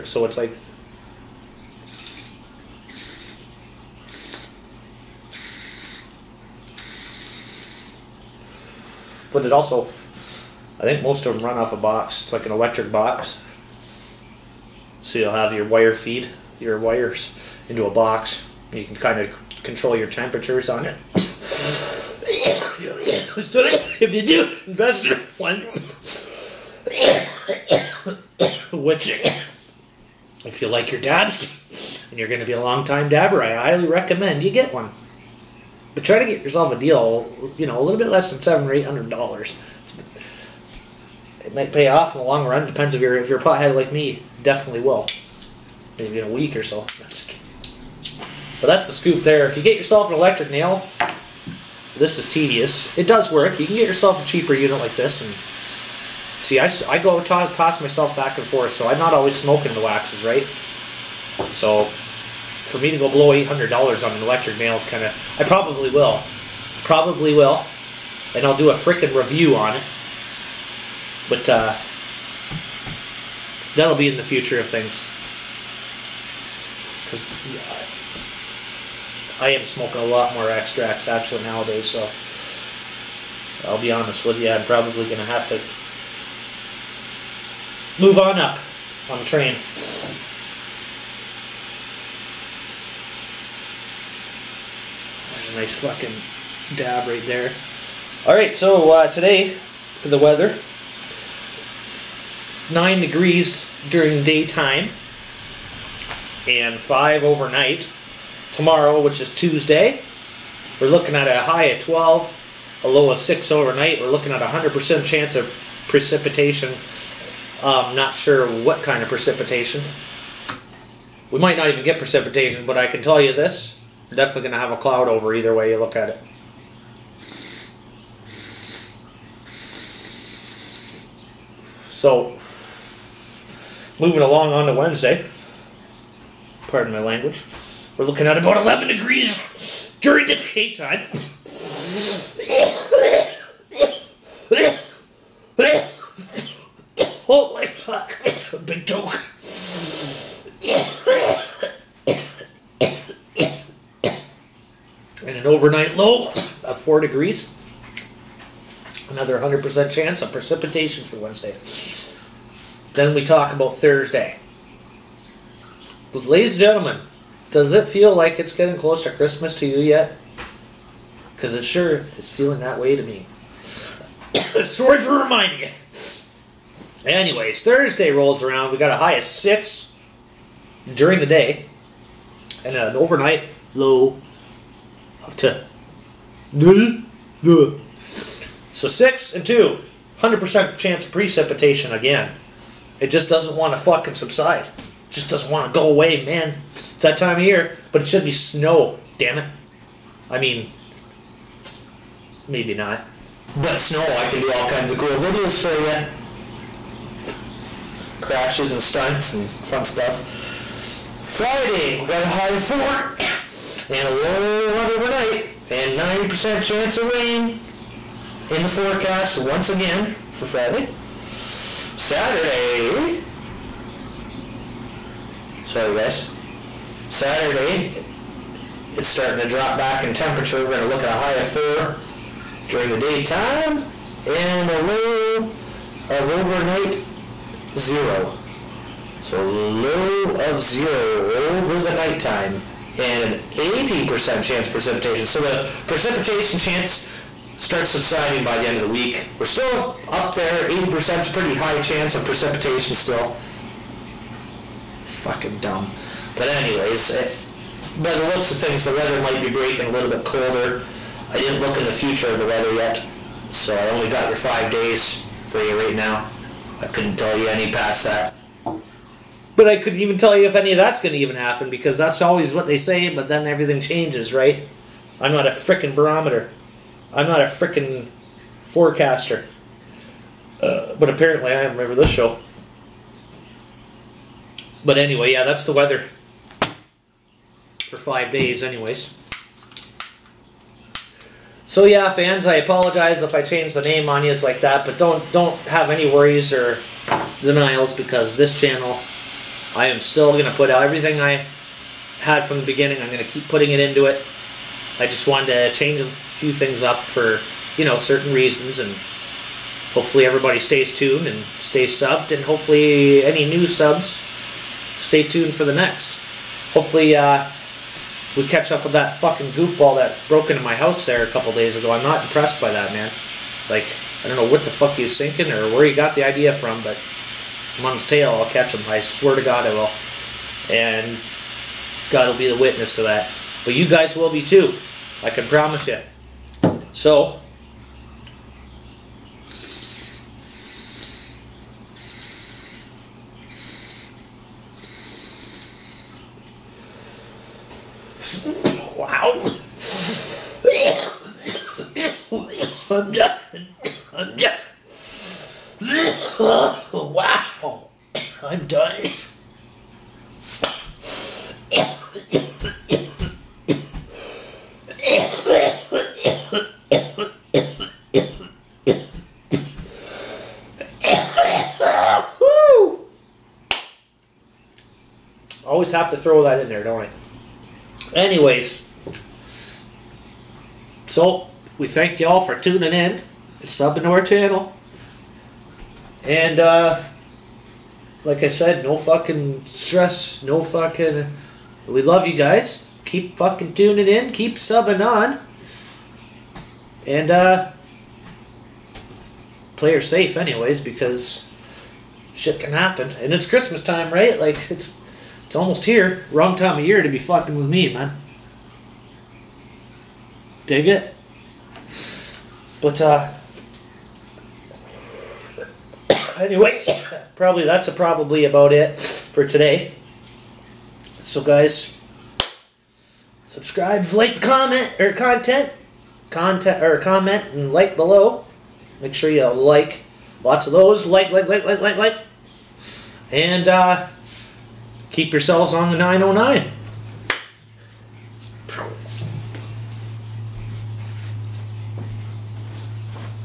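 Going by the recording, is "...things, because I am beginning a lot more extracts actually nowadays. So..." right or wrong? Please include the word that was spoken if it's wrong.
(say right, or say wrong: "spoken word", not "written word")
wrong: "smoking", not "beginning".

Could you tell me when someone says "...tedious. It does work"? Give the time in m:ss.
0:52.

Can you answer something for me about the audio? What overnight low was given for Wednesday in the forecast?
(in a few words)
4 degrees.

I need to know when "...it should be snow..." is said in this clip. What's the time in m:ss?
3:18.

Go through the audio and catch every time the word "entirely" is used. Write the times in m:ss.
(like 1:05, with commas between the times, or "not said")
not said.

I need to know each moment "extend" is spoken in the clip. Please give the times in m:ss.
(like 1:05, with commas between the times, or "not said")
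not said.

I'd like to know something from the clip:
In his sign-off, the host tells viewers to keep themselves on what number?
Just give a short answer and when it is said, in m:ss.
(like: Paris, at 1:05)
909, at 7:15.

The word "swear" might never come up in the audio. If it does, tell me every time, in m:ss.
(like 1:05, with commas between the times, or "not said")
5:28.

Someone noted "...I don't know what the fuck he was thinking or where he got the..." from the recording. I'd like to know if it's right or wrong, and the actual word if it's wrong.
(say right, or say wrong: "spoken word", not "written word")
right.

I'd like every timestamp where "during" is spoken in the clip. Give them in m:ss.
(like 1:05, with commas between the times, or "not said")
1:43, 2:20, 3:00, 3:52.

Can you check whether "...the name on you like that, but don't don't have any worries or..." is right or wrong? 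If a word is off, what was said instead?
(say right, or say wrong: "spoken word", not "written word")
right.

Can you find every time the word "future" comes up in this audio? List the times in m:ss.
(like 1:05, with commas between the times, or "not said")
1:14, 4:21.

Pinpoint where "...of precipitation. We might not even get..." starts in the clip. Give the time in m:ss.
1:59.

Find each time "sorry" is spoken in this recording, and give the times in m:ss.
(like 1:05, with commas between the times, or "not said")
2:54, 3:45.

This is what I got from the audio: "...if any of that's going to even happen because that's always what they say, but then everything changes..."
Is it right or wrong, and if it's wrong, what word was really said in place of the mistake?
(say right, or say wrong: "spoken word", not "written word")
right.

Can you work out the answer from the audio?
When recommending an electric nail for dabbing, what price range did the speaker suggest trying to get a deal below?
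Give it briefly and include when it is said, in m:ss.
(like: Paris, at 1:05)
700 or 800 dollars, at 0:38.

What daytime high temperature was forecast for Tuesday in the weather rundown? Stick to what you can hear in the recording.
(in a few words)
12.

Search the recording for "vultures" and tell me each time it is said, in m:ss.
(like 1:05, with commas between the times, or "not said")
not said.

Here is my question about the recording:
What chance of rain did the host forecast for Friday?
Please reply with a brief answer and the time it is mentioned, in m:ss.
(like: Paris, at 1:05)
90%, at 3:35.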